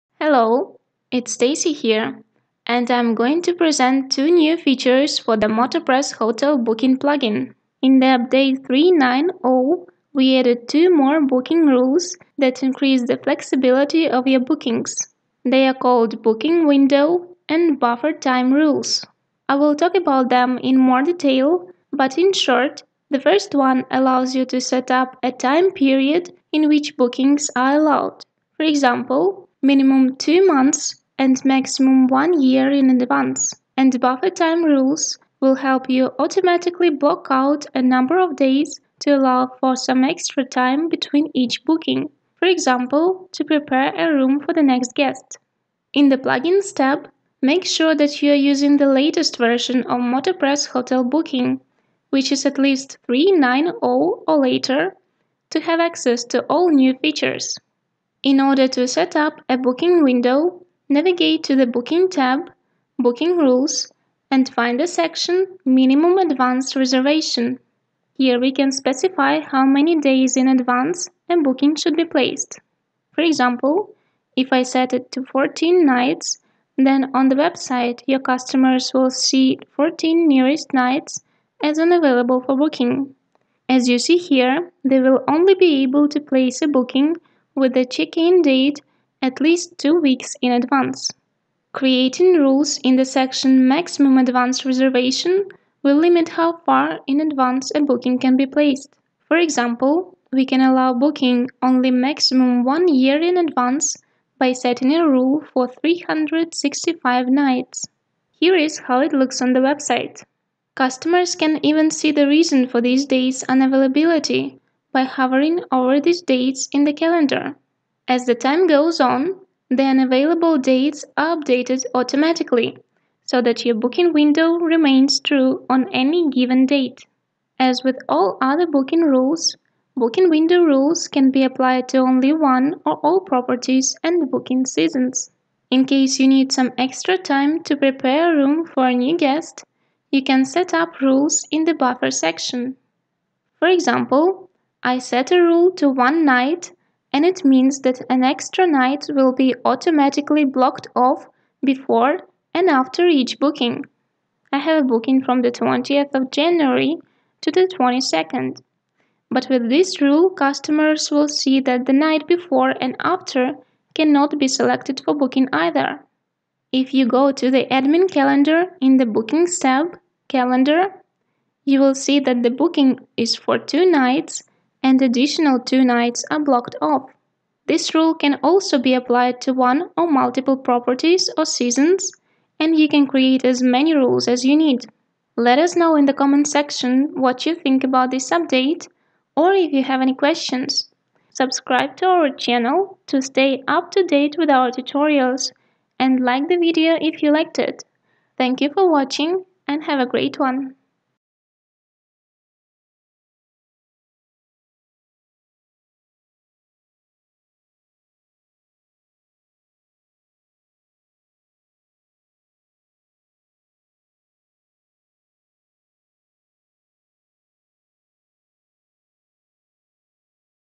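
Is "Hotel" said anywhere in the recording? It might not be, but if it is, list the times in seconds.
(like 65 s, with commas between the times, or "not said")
6 s, 50 s.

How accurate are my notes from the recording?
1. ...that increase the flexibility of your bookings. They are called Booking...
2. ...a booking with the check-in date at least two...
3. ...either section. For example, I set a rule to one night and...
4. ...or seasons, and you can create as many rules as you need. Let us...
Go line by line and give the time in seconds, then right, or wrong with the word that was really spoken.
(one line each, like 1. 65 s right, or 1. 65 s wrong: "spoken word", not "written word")
1. 12 s right
2. 86 s right
3. 141 s wrong: "buffer", not "either"
4. 181 s right.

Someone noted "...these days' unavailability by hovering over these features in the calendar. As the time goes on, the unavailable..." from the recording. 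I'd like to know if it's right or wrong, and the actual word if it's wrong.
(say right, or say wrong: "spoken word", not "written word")
wrong: "dates", not "features".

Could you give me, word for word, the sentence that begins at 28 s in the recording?
For example, minimum two months and maximum one year in advance.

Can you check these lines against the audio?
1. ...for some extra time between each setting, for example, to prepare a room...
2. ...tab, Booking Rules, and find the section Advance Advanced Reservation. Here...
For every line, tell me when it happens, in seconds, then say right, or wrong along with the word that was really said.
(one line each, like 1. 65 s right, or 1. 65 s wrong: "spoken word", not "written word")
1. 39 s wrong: "booking", not "setting"
2. 62 s wrong: "Minimum", not "Advance".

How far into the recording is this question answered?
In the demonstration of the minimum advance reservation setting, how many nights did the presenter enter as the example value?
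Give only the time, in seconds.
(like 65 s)
75 s.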